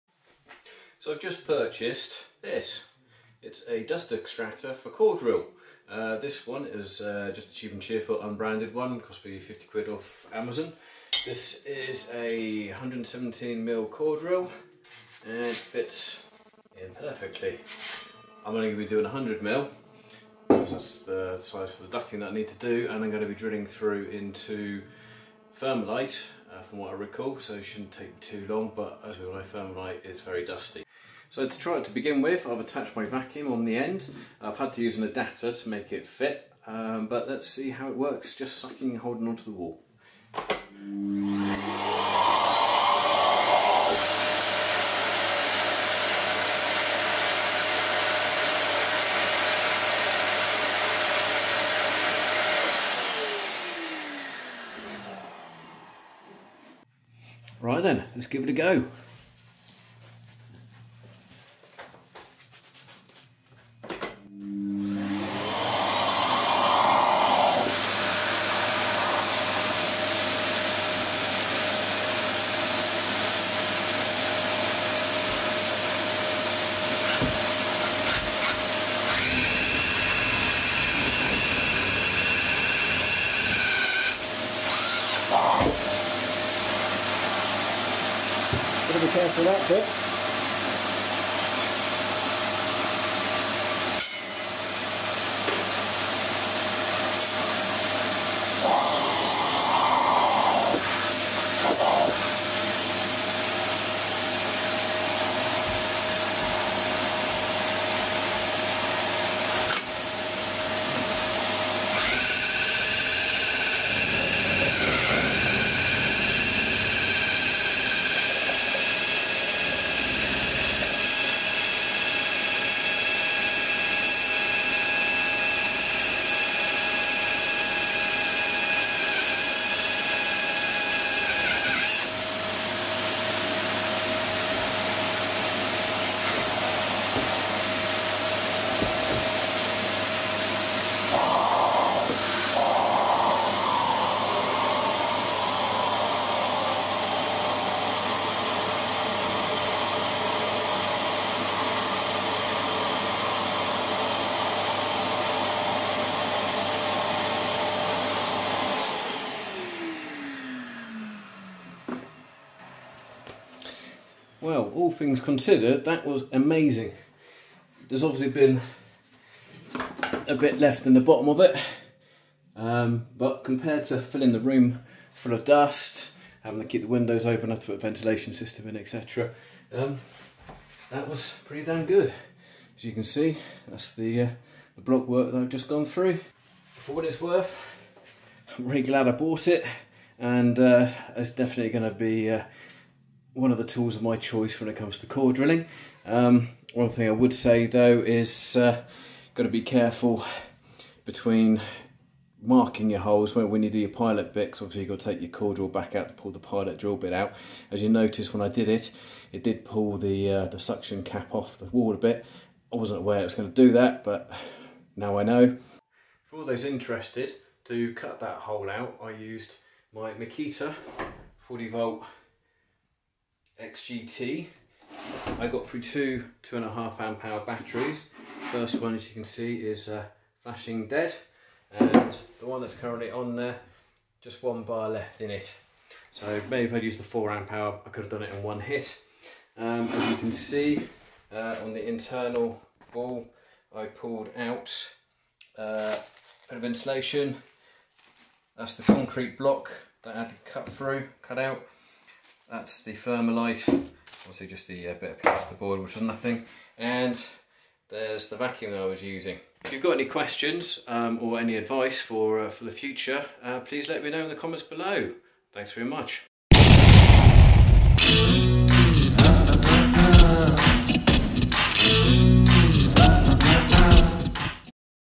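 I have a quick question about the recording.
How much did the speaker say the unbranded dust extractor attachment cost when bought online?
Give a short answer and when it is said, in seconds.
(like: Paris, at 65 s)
50 quid, at 9 s.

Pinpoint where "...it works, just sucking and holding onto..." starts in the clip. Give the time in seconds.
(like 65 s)
37 s.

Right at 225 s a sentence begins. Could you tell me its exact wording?
I got through two two and a half amp hour batteries.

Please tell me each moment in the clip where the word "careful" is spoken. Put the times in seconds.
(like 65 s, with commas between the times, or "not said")
89 s, 199 s.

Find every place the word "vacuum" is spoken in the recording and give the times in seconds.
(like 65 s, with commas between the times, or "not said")
33 s, 258 s.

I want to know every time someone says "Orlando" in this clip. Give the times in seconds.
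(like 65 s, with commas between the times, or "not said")
not said.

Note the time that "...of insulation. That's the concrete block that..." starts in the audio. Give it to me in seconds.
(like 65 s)
246 s.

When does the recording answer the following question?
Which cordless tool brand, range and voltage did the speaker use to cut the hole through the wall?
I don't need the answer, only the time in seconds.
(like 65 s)
220 s.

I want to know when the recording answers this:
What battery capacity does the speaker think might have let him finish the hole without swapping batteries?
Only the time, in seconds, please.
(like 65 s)
237 s.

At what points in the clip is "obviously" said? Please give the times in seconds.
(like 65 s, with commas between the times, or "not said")
168 s, 204 s, 253 s.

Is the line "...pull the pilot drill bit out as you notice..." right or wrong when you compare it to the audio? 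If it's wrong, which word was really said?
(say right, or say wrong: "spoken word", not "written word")
right.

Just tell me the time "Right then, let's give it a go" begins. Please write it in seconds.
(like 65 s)
57 s.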